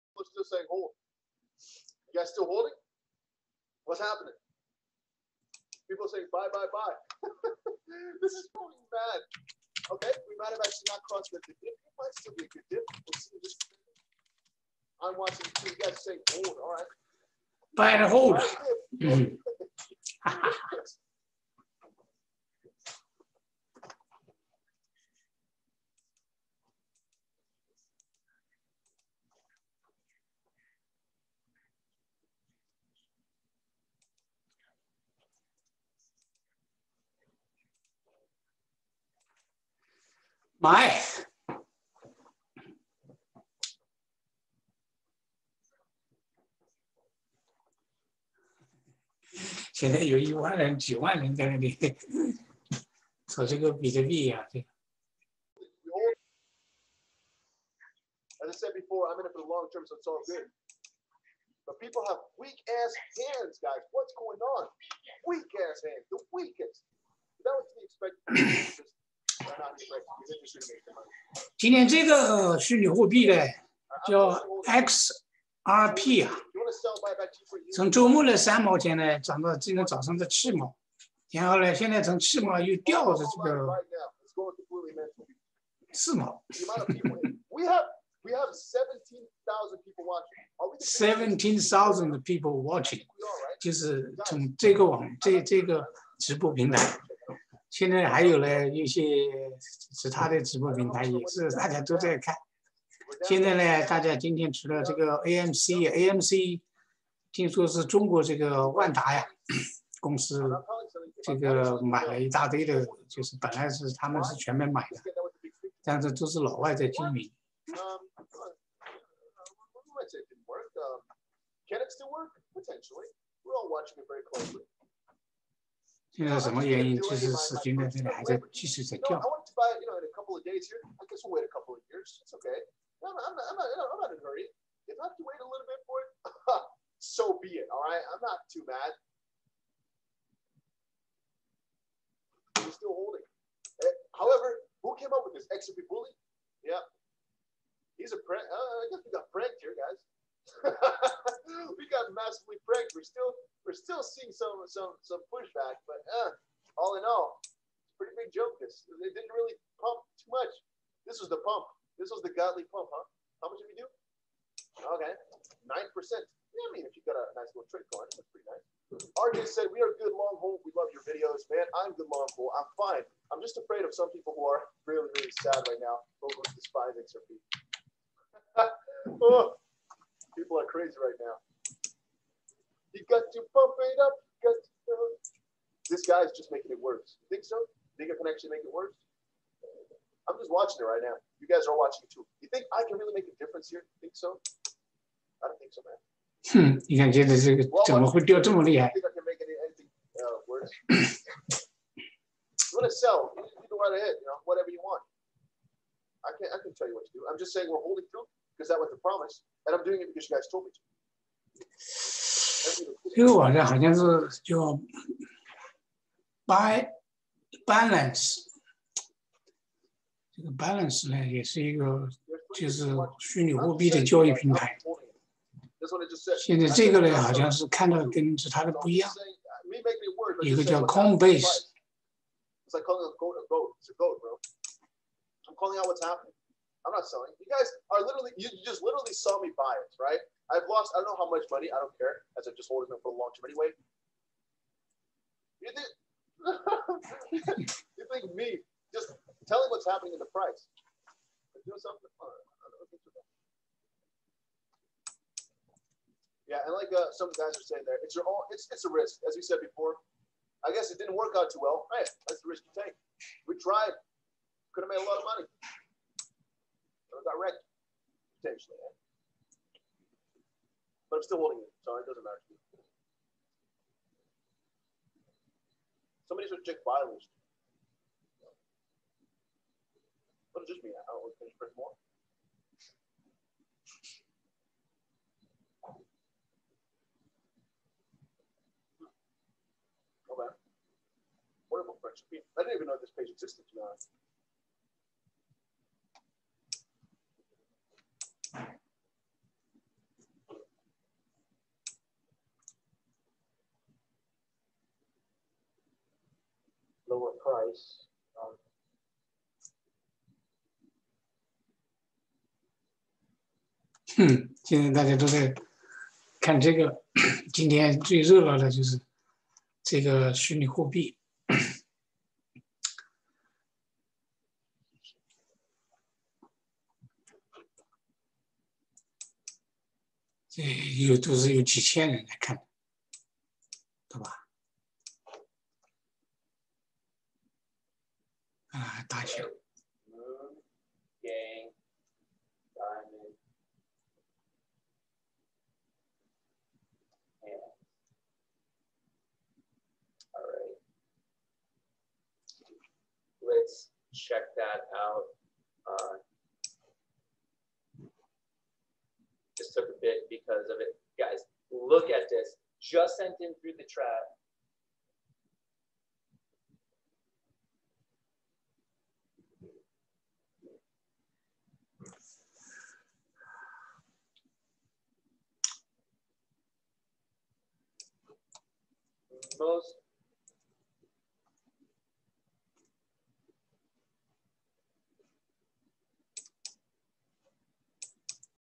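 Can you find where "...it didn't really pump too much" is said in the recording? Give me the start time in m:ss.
2:38.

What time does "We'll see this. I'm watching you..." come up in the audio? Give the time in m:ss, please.
0:12.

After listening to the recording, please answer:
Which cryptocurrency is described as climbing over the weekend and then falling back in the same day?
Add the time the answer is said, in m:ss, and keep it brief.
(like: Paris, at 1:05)
XRP, at 1:14.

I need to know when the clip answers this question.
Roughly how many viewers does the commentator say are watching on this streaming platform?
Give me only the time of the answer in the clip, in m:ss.
1:30.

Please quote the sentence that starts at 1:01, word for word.
But people have weak ass hands, guys.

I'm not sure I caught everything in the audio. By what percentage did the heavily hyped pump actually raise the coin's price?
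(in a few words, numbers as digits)
9%.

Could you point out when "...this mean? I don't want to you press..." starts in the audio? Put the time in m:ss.
4:40.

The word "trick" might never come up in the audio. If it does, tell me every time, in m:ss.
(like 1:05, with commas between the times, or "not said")
2:47.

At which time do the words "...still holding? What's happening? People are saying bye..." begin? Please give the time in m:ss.
0:02.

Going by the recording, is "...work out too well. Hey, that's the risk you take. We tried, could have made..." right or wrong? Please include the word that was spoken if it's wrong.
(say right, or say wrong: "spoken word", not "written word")
right.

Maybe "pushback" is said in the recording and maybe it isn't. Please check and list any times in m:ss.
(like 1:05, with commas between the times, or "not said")
2:35.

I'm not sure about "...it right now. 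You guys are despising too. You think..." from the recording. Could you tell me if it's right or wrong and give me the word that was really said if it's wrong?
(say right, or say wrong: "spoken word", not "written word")
wrong: "watching", not "despising".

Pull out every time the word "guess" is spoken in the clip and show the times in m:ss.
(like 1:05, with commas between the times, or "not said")
2:28, 4:20.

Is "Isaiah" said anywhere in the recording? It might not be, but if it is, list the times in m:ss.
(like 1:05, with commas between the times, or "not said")
not said.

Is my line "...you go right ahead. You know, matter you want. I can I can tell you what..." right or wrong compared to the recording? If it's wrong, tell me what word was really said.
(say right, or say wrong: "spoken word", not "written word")
wrong: "whatever", not "matter".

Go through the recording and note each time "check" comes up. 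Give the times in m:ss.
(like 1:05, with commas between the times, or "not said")
4:36, 5:54.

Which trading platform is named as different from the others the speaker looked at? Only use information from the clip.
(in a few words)
Coinbase.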